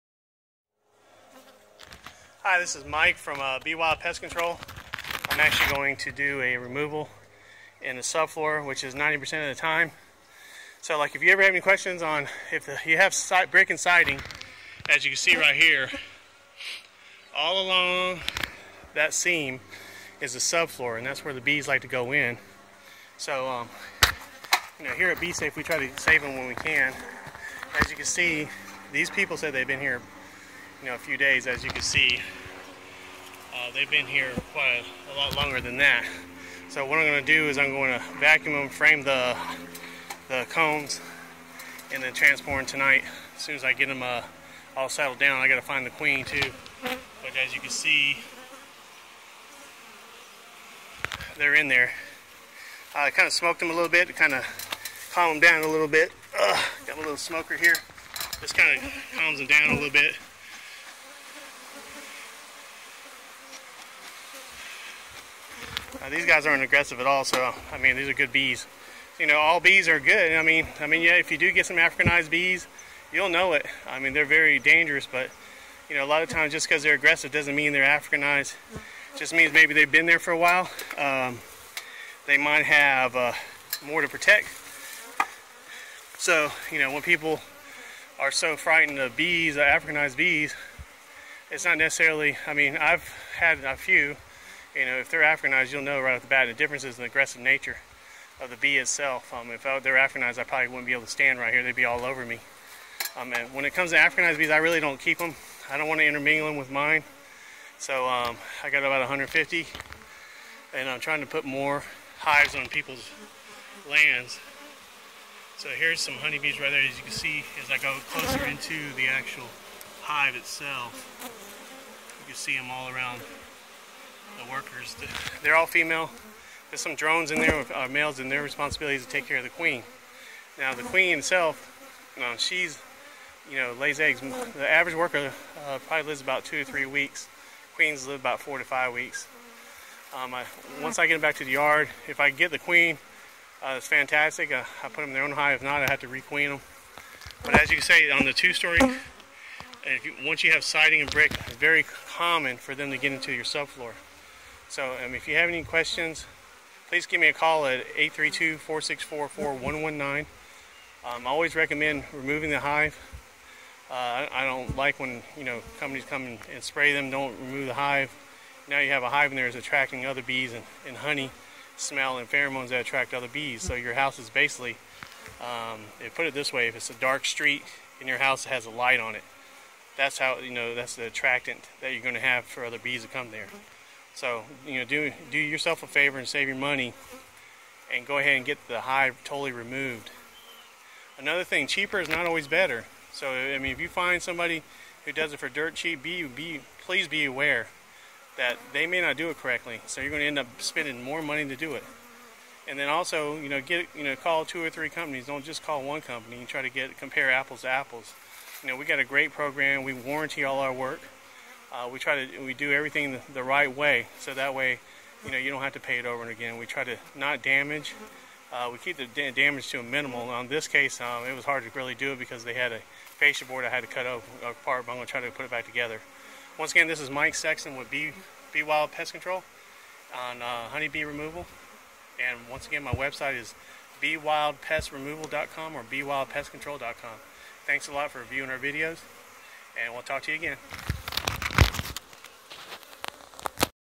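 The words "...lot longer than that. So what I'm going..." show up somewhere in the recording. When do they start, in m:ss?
0:35.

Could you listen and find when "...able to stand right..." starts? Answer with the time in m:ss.
1:40.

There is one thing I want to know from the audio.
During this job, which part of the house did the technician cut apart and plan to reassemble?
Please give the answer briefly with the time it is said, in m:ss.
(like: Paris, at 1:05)
Fascia board, at 3:43.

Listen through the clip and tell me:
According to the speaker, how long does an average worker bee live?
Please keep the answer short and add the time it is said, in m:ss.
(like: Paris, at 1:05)
2 to 3 weeks, at 2:16.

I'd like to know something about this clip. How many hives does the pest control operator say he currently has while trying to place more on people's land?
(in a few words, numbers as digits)
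150.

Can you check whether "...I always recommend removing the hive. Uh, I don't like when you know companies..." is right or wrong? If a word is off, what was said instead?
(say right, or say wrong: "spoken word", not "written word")
right.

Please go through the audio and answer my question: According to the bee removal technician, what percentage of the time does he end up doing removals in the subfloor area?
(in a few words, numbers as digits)
90%.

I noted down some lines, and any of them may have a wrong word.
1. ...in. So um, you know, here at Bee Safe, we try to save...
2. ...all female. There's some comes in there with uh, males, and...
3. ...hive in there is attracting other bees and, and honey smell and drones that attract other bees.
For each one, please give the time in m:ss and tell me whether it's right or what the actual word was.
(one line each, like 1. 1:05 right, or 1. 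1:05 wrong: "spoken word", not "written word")
1. 0:22 right
2. 2:05 wrong: "drones", not "comes"
3. 2:49 wrong: "pheromones", not "drones".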